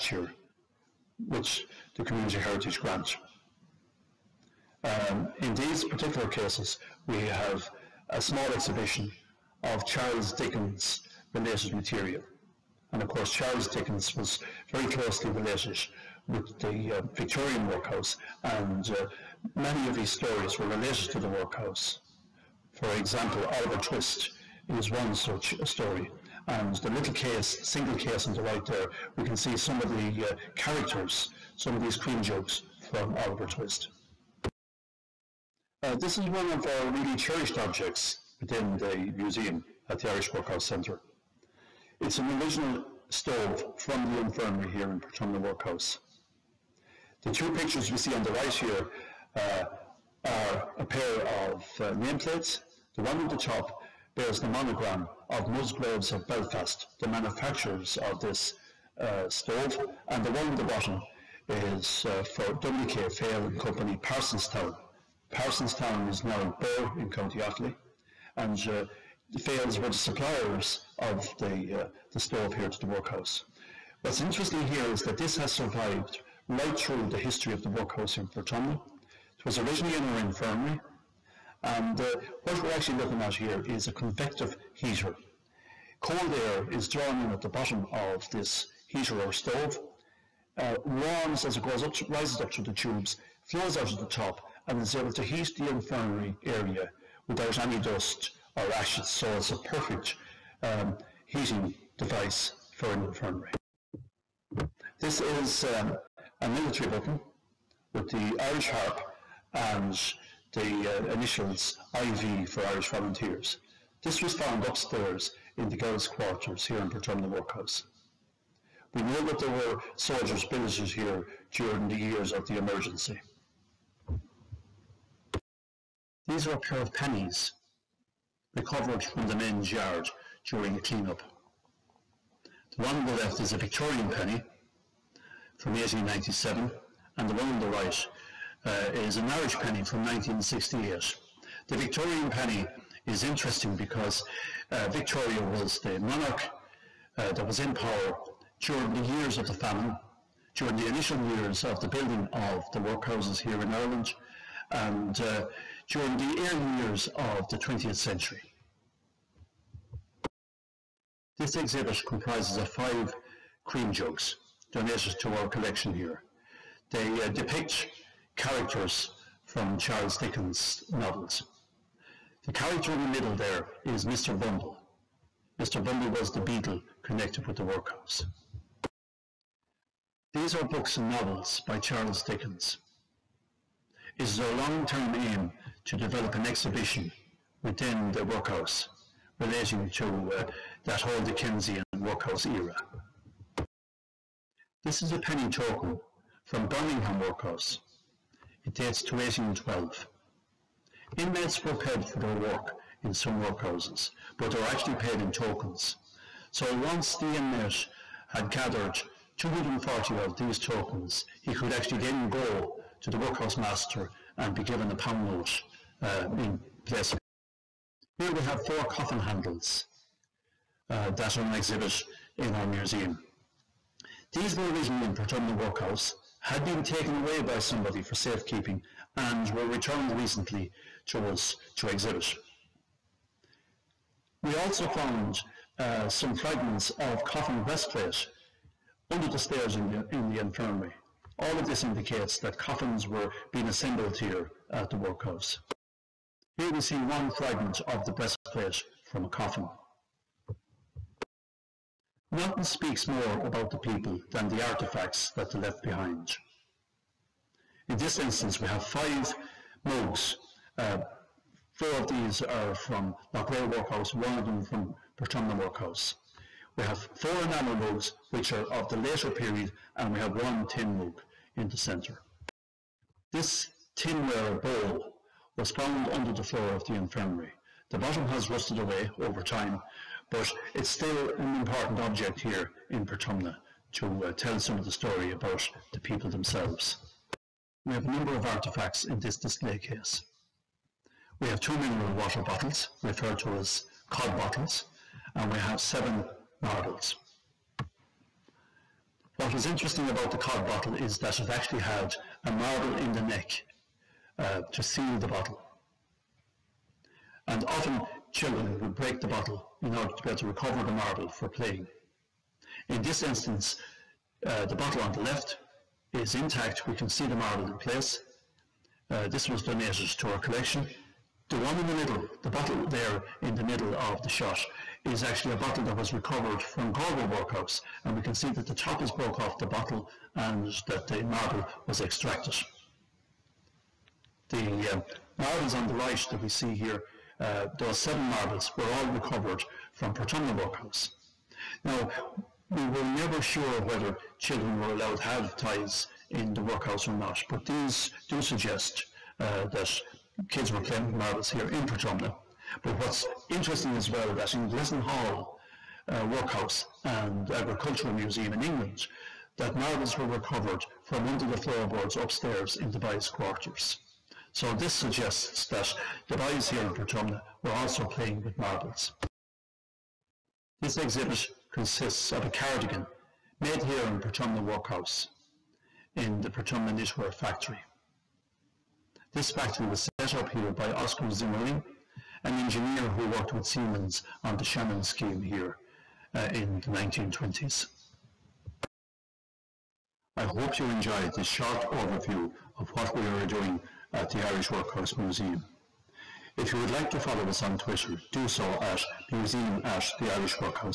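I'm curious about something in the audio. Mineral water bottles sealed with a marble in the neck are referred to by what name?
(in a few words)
cod bottles.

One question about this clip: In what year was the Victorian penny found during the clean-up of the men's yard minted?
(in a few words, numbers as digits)
1897.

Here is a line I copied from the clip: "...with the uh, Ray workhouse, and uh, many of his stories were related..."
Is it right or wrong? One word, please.
wrong.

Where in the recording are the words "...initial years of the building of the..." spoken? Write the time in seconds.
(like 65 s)
150 s.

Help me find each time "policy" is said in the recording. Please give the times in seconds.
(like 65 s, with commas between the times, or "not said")
not said.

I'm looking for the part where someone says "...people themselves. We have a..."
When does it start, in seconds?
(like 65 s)
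285 s.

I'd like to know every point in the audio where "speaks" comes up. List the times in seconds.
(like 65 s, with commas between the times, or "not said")
252 s.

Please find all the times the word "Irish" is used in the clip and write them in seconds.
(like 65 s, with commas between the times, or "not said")
40 s, 108 s, 112 s, 139 s, 394 s, 400 s.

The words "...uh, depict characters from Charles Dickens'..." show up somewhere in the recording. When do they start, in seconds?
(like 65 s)
167 s.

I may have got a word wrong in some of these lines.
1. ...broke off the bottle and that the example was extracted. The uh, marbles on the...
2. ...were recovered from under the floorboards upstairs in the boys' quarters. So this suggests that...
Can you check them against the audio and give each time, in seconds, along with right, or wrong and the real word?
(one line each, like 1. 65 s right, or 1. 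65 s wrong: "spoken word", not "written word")
1. 329 s wrong: "marble", not "example"
2. 360 s right.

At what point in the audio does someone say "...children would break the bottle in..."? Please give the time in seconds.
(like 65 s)
308 s.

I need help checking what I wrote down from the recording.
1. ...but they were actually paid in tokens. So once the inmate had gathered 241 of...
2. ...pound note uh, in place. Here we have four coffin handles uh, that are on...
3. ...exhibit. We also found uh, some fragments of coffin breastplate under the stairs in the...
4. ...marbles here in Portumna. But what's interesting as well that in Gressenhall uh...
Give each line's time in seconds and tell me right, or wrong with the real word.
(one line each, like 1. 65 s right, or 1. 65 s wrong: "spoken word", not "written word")
1. 204 s wrong: "240", not "241"
2. 214 s right
3. 231 s right
4. 351 s right.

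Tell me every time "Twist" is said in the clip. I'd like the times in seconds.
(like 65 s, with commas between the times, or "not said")
23 s, 33 s.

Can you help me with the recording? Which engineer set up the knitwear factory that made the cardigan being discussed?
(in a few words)
Oscar Zimmerling.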